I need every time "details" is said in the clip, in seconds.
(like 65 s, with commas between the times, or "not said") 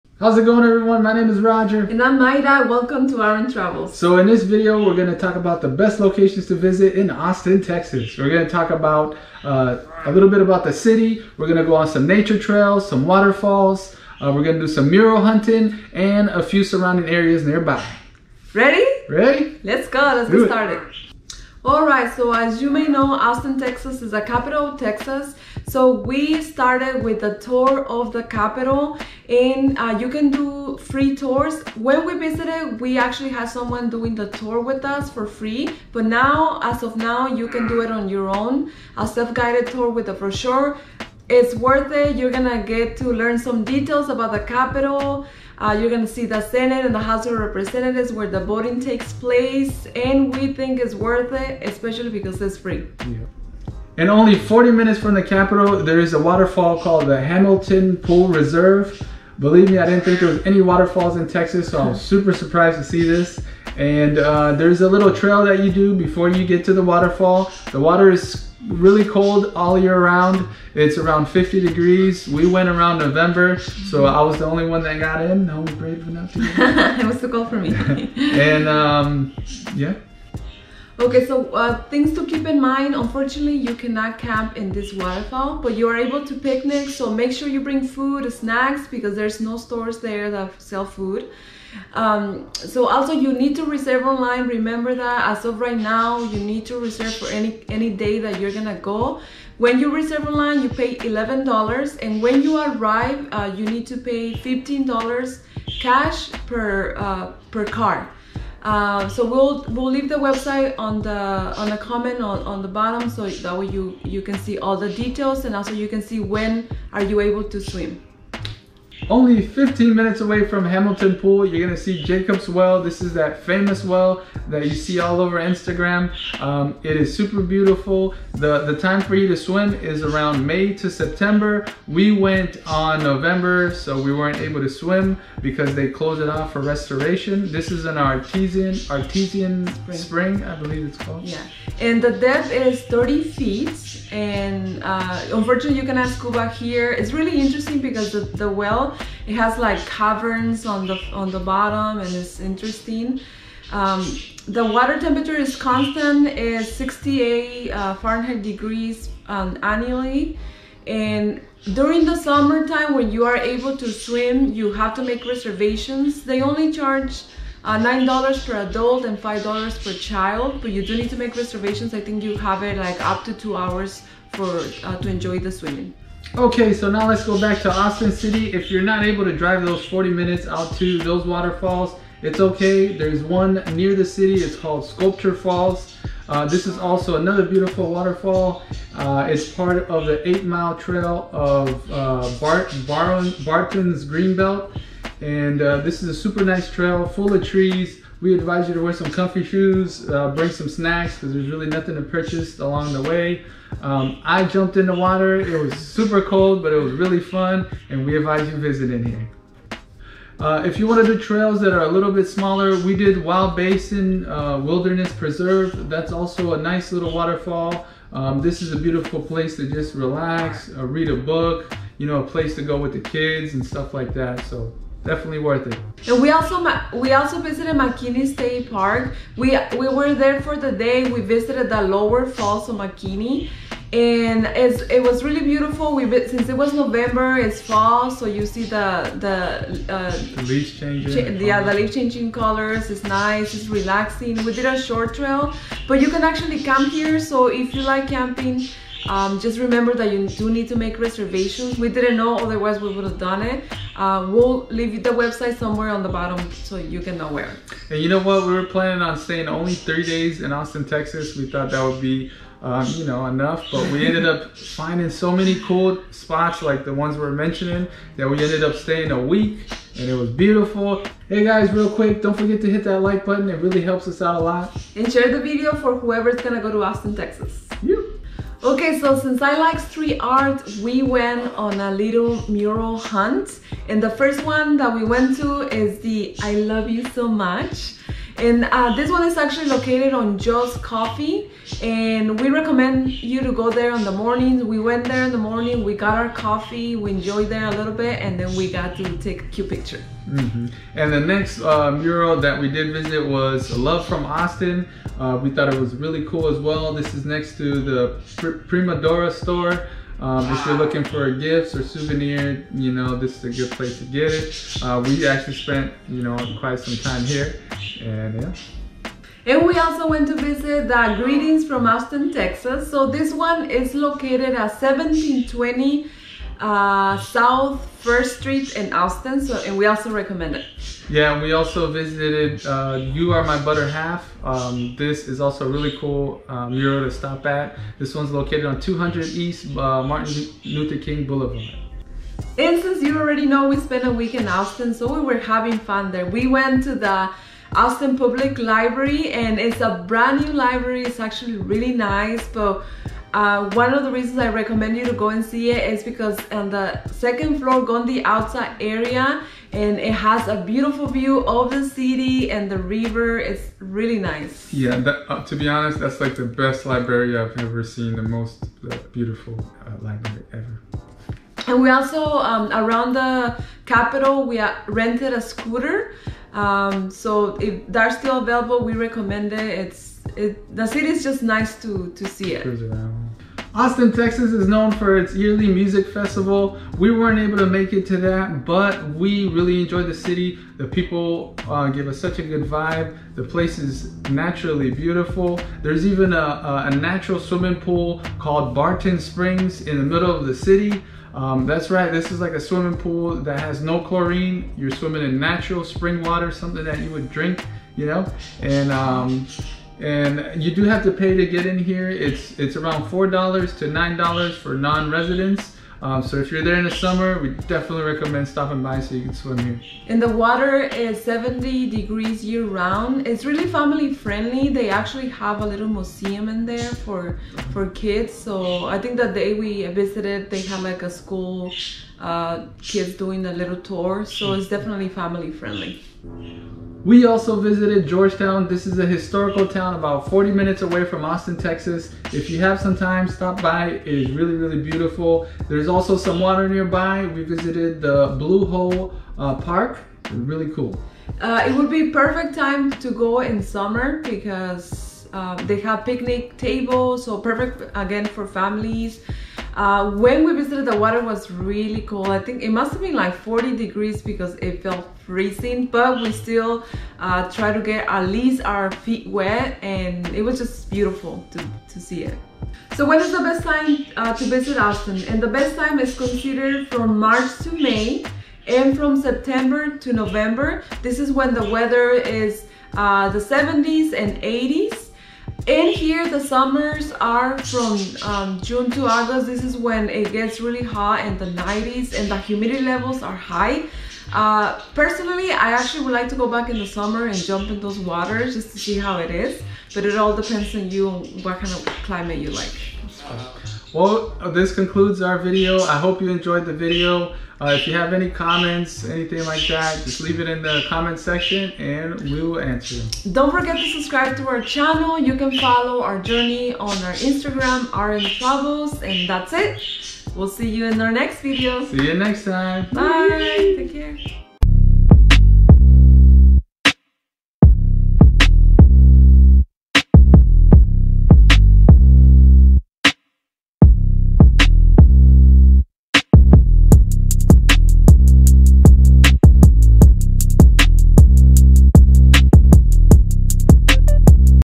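43 s, 114 s.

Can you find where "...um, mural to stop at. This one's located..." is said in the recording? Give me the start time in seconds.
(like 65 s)
336 s.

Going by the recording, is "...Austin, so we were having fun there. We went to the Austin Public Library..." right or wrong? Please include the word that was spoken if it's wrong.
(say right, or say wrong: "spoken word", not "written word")
right.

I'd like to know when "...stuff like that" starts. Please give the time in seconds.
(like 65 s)
223 s.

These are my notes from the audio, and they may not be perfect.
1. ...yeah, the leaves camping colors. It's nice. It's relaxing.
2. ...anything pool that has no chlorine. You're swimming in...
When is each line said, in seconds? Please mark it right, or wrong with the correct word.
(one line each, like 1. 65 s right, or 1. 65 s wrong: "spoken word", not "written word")
1. 241 s wrong: "changing", not "camping"
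2. 402 s wrong: "swimming", not "anything".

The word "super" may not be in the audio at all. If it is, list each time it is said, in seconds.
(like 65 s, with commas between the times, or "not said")
61 s, 127 s, 196 s, 205 s.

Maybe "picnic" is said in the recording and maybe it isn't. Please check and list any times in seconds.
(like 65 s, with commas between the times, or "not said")
86 s, 456 s.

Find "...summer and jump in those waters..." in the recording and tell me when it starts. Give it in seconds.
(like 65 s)
496 s.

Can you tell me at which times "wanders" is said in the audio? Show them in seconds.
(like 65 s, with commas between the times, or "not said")
not said.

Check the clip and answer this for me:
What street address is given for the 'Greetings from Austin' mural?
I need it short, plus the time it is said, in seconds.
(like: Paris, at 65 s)
1720 South First Street, at 324 s.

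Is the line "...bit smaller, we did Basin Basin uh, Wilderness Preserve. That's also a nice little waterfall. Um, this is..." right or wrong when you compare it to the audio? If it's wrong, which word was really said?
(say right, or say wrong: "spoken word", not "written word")
wrong: "Wild", not "Basin".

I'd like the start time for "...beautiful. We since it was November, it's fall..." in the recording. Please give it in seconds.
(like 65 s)
235 s.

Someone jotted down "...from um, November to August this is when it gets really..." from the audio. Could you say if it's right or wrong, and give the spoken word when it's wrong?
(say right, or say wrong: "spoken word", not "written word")
wrong: "June", not "November".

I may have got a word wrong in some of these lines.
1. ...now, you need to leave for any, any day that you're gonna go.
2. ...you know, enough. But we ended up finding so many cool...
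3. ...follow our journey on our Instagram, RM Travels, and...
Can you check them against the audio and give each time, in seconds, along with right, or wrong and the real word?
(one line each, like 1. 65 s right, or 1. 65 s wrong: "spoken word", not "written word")
1. 95 s wrong: "reserve", not "leave"
2. 262 s right
3. 515 s right.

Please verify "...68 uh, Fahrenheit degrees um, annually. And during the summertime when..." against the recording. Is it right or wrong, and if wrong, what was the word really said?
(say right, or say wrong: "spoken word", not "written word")
right.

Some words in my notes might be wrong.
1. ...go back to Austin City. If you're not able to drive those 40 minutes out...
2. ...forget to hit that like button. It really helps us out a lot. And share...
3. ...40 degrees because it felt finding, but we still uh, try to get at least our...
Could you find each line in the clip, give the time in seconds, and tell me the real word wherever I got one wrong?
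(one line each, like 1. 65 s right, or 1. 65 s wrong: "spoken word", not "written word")
1. 177 s right
2. 272 s right
3. 463 s wrong: "freezing", not "finding".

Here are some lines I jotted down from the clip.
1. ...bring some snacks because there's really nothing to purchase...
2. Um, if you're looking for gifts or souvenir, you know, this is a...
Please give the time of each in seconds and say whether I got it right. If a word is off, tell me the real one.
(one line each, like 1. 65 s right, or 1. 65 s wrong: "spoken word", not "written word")
1. 200 s right
2. 310 s right.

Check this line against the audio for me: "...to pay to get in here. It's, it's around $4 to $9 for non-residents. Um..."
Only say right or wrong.
right.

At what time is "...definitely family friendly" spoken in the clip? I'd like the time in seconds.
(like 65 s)
434 s.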